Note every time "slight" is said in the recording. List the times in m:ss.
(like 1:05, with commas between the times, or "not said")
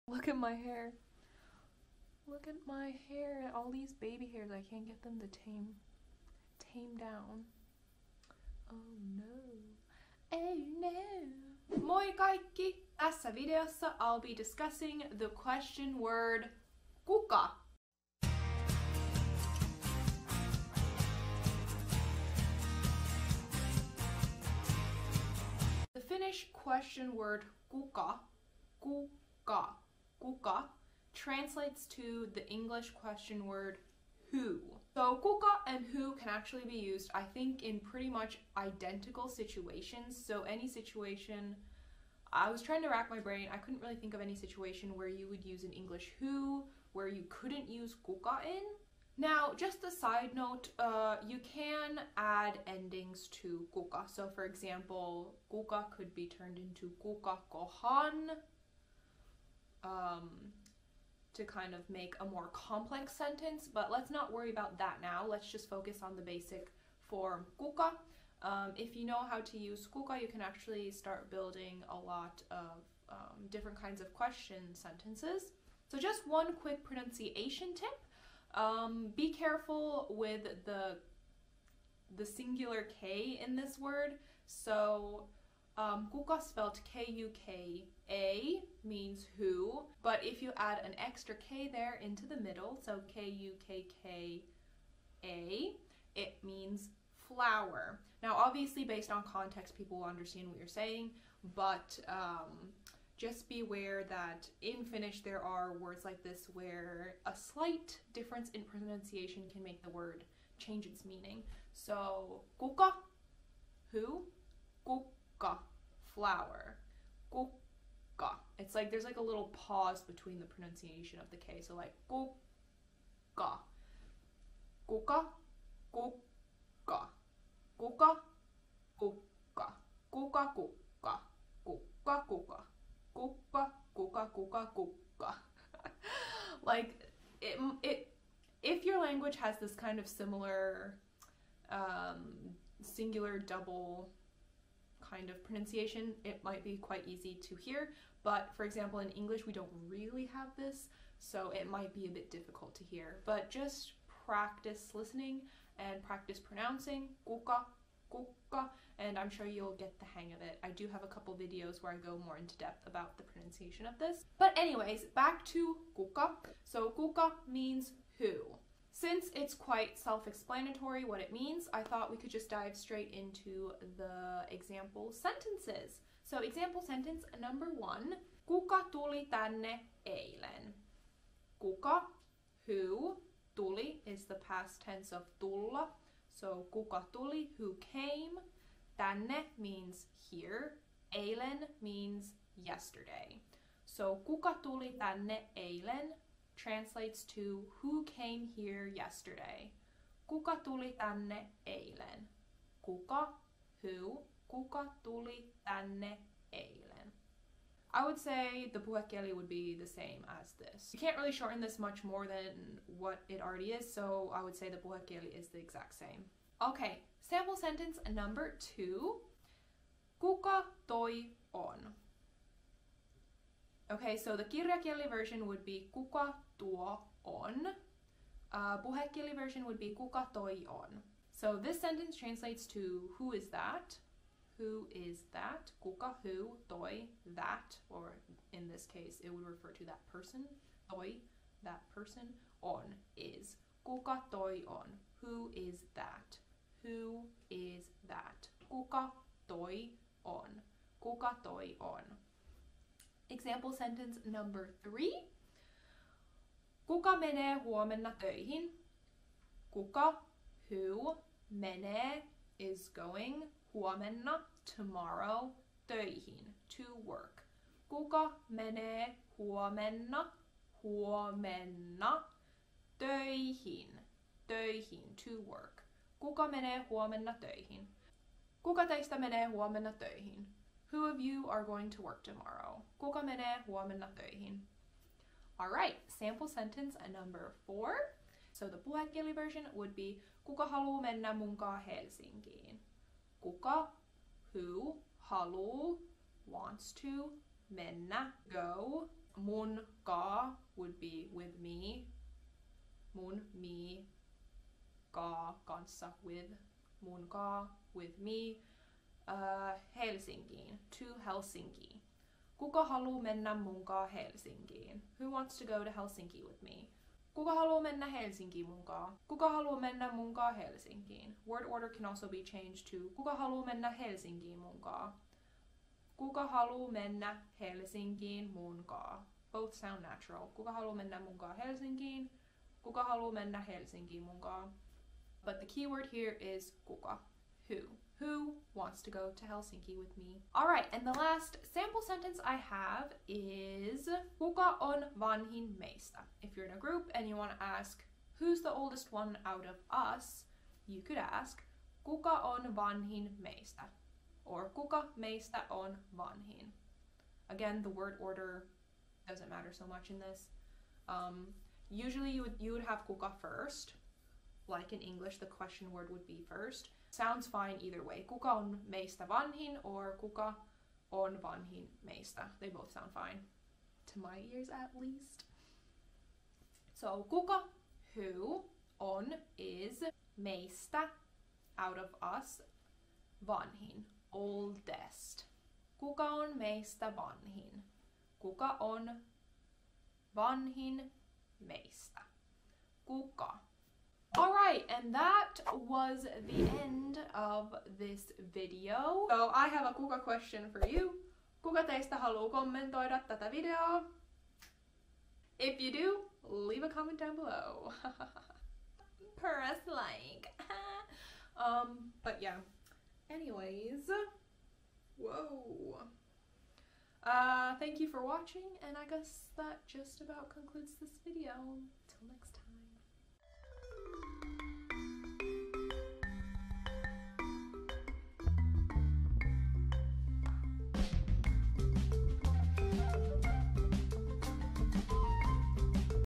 1:47.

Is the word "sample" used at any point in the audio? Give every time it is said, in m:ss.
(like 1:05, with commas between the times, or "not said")
3:37, 4:46, 5:41.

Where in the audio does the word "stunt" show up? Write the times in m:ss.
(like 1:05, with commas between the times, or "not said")
not said.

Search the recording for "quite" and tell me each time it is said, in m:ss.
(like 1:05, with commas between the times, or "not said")
2:26, 2:49.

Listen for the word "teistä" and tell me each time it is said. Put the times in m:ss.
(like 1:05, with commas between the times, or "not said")
4:38, 6:41.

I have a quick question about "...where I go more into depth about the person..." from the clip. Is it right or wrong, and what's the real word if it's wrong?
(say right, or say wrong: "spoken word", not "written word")
wrong: "pronunciation", not "person".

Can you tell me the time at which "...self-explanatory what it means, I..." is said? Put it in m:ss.
2:49.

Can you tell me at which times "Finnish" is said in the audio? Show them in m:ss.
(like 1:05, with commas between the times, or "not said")
0:26, 1:44.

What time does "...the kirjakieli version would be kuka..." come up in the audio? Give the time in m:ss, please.
3:44.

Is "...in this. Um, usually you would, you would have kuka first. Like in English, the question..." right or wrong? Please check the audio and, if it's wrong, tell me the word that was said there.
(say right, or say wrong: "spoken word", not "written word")
right.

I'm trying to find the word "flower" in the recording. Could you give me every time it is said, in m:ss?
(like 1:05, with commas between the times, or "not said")
1:37, 1:56.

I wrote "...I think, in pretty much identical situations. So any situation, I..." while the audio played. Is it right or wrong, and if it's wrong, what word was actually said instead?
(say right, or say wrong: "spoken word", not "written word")
right.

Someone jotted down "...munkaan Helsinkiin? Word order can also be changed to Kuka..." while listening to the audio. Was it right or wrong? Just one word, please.
right.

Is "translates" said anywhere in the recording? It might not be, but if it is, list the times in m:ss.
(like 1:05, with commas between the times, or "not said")
0:31, 3:16, 3:52.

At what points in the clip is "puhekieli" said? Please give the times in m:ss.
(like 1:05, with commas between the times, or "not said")
3:28, 3:34, 3:48, 4:48.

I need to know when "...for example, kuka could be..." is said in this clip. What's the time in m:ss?
0:54.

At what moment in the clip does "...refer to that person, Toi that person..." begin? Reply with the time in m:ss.
3:59.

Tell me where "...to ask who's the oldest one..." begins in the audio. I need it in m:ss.
5:47.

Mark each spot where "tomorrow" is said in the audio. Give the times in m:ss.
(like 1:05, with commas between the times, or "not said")
4:24, 4:42.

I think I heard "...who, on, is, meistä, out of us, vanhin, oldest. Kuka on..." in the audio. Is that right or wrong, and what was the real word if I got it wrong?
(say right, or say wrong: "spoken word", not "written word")
right.